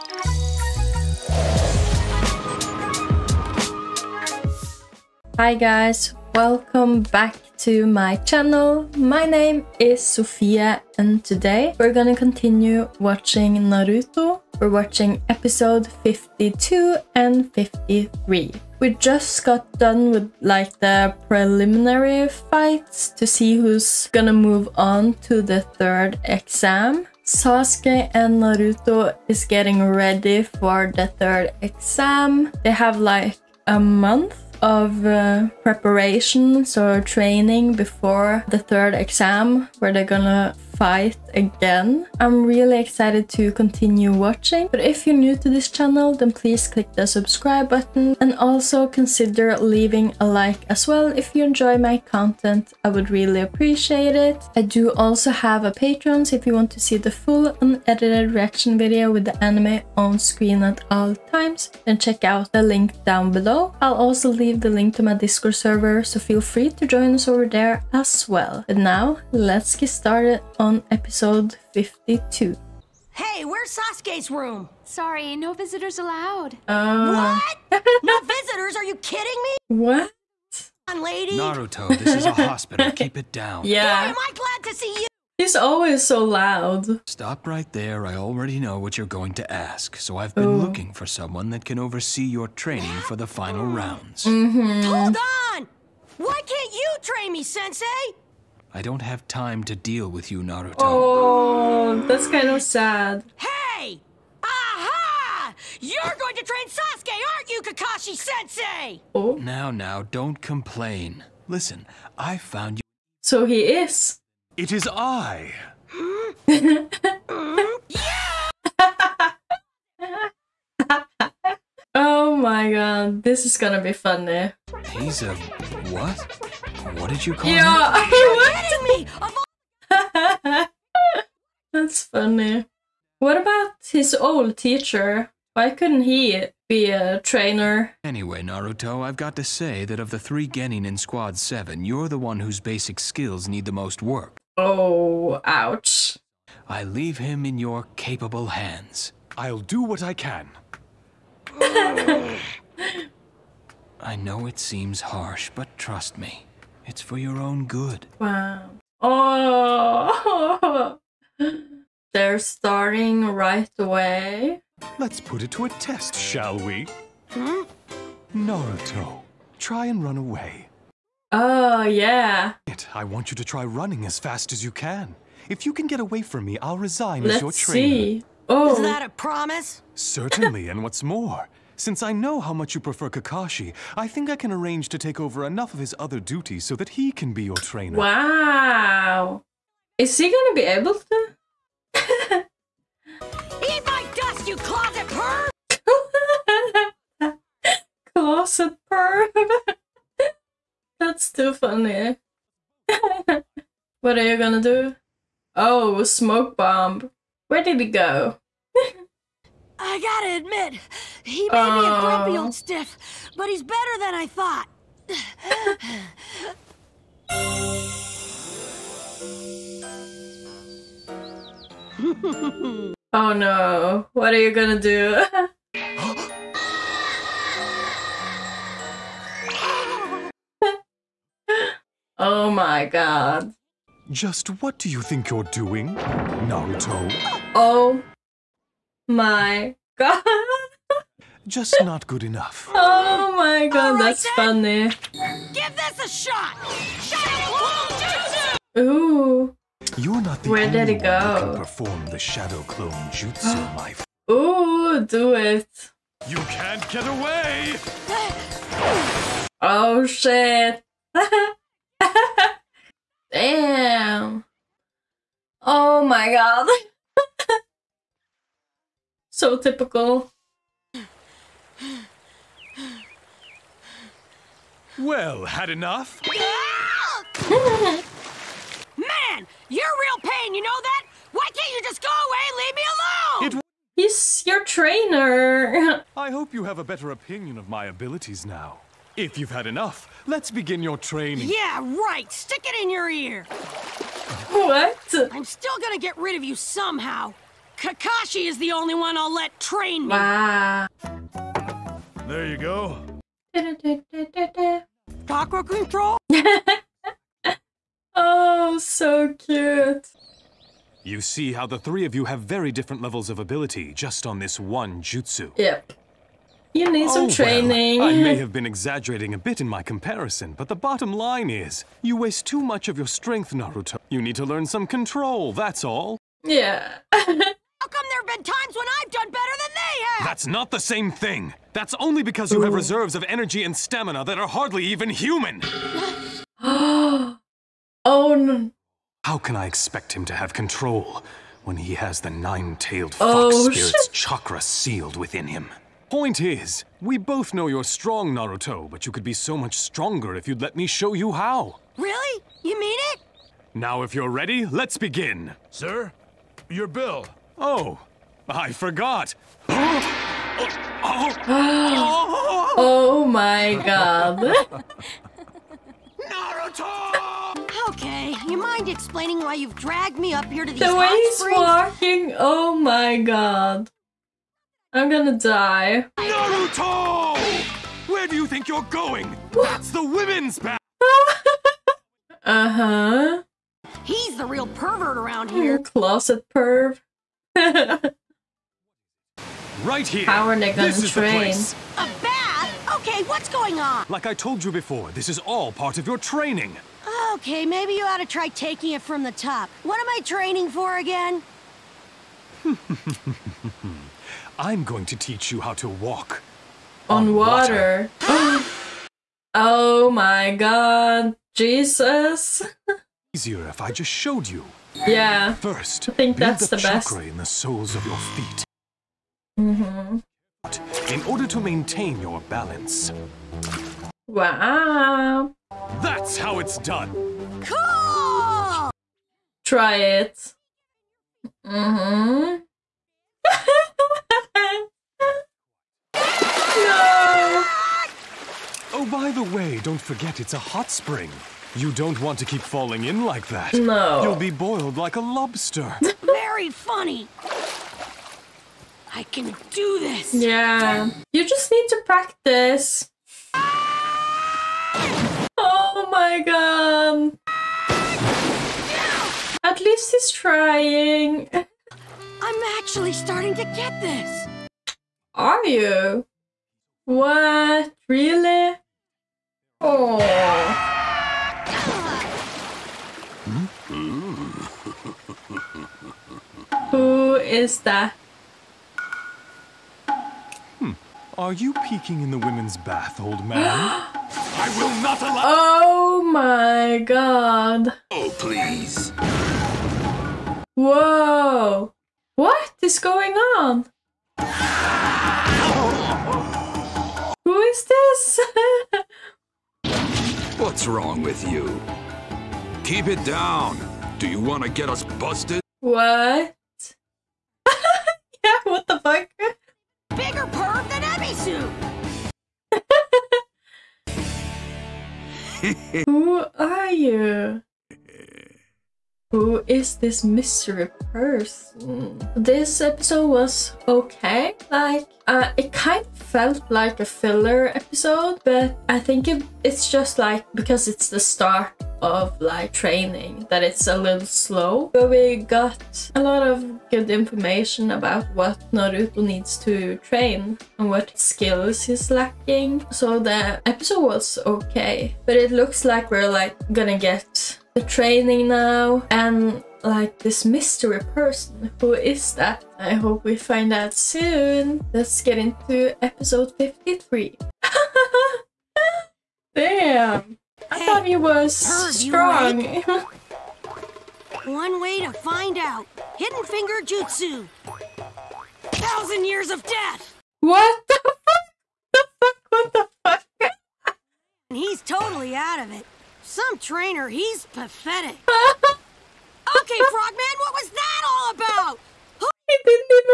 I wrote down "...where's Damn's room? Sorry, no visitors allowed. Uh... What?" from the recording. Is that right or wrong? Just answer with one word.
wrong.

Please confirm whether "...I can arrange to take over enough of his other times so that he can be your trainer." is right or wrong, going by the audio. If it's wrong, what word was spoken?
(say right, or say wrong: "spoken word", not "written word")
wrong: "duties", not "times".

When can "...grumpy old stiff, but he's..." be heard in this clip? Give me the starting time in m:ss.
3:31.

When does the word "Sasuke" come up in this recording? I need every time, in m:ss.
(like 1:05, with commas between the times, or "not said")
0:27, 1:13, 1:46.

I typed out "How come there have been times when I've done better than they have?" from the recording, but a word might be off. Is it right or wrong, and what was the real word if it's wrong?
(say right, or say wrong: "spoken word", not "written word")
right.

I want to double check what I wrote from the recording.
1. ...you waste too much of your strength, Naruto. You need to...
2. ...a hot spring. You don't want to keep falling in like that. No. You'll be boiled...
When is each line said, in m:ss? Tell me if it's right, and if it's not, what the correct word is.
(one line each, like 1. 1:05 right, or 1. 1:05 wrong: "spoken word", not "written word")
1. 5:22 right
2. 7:20 right.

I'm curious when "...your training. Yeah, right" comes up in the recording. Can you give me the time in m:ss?
4:50.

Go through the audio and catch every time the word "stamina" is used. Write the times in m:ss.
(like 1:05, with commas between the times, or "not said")
5:33.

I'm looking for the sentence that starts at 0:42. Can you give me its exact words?
I'm really excited to continue watching.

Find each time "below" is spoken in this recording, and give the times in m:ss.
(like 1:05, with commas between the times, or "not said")
1:03.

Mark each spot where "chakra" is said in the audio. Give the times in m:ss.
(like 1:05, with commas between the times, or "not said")
5:05, 5:44.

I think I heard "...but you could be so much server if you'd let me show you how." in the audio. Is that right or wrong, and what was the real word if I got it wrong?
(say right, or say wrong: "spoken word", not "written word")
wrong: "stronger", not "server".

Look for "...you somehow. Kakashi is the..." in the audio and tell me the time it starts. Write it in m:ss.
4:56.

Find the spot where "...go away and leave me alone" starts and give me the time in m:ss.
4:42.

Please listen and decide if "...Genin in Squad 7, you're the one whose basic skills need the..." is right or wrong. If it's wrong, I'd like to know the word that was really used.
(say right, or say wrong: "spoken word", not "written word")
right.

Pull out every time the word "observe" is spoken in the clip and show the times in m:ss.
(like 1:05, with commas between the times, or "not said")
not said.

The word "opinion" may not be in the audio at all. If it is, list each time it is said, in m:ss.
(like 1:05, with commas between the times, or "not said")
4:47.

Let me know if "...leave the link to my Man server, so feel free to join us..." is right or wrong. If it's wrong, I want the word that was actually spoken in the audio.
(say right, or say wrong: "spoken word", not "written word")
wrong: "Discord", not "Man".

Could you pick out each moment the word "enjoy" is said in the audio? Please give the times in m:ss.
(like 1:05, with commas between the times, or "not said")
0:51.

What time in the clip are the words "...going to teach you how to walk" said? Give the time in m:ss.
6:44.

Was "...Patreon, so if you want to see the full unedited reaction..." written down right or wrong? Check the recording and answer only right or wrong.
right.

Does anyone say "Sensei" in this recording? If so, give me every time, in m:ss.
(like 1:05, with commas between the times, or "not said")
1:37, 1:48.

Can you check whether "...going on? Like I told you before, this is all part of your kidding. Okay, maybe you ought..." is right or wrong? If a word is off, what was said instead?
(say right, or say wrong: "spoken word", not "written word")
wrong: "training", not "kidding".